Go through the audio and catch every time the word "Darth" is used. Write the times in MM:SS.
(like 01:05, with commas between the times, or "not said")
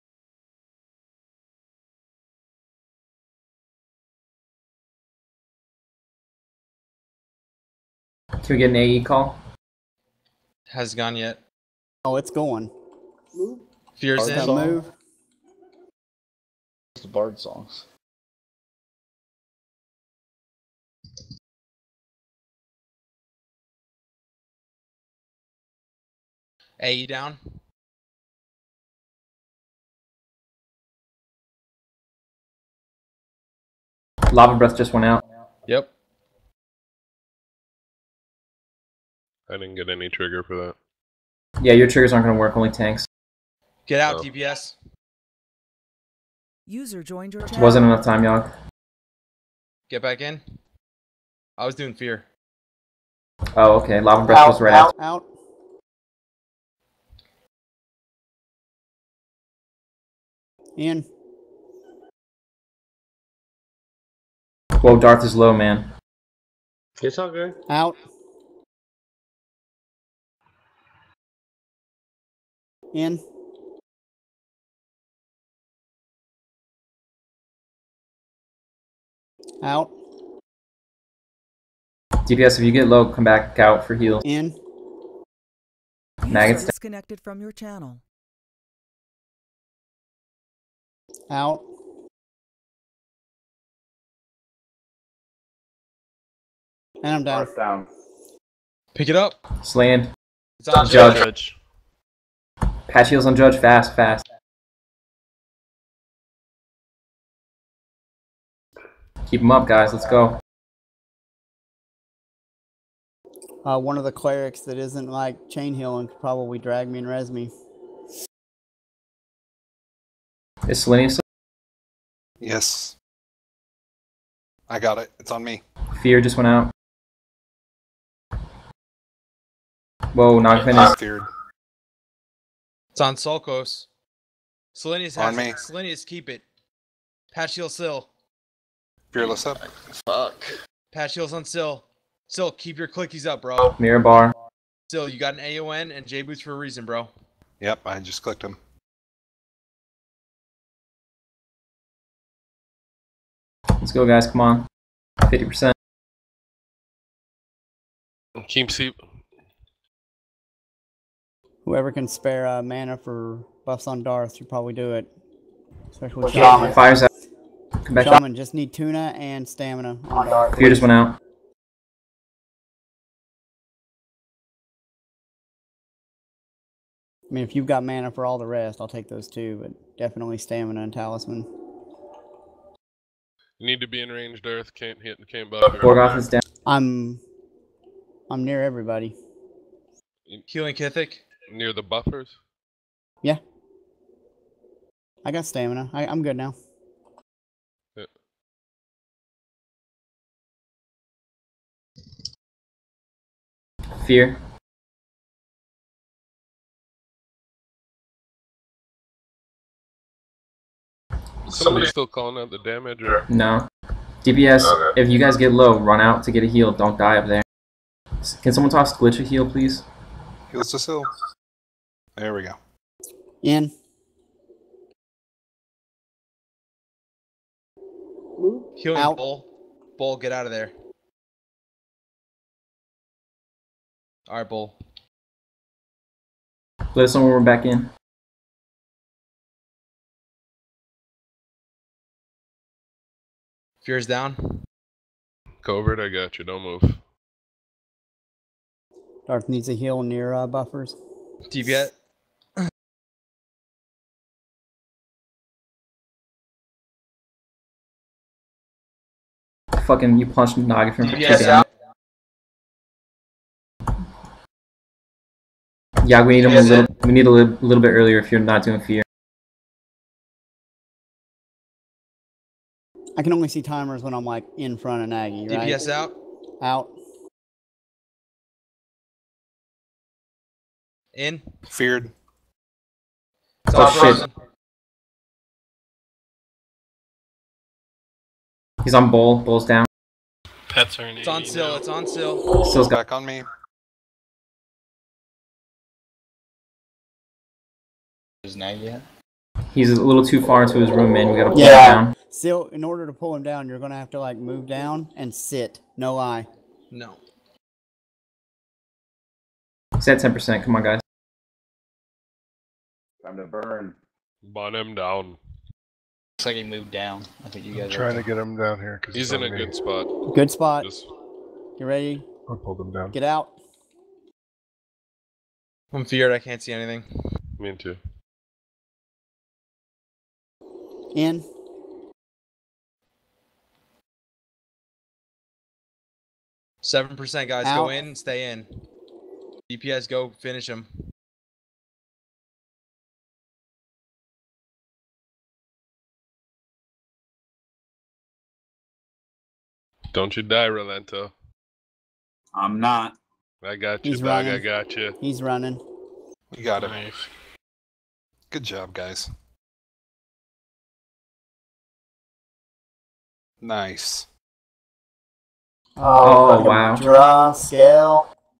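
01:04, 02:44, 02:50, 04:09.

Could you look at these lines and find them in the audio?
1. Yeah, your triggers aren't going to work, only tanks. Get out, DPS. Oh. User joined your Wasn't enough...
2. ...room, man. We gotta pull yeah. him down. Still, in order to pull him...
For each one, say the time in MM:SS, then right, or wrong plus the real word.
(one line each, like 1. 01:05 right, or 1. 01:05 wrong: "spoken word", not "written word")
1. 00:41 right
2. 05:00 right.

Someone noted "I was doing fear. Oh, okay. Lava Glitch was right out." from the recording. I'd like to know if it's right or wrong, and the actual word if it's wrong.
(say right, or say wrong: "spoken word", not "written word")
wrong: "Breath", not "Glitch".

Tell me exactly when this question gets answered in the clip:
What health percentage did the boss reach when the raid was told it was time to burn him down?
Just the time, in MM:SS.
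05:10.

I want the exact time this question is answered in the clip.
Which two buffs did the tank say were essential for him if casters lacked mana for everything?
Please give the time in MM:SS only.
03:00.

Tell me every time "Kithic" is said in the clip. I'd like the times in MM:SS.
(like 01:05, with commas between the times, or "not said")
03:10.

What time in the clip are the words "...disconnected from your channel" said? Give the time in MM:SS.
01:26.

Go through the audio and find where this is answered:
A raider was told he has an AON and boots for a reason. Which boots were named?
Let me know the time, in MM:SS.
02:26.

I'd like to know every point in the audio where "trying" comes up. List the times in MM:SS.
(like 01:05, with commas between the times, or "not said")
05:17.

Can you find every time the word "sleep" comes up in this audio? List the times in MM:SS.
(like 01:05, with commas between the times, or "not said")
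02:38.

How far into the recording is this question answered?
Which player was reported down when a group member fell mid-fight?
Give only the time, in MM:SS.
03:05.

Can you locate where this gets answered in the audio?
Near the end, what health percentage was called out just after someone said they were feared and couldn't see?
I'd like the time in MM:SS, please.
05:36.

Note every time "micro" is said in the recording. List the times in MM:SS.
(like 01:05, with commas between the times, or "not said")
not said.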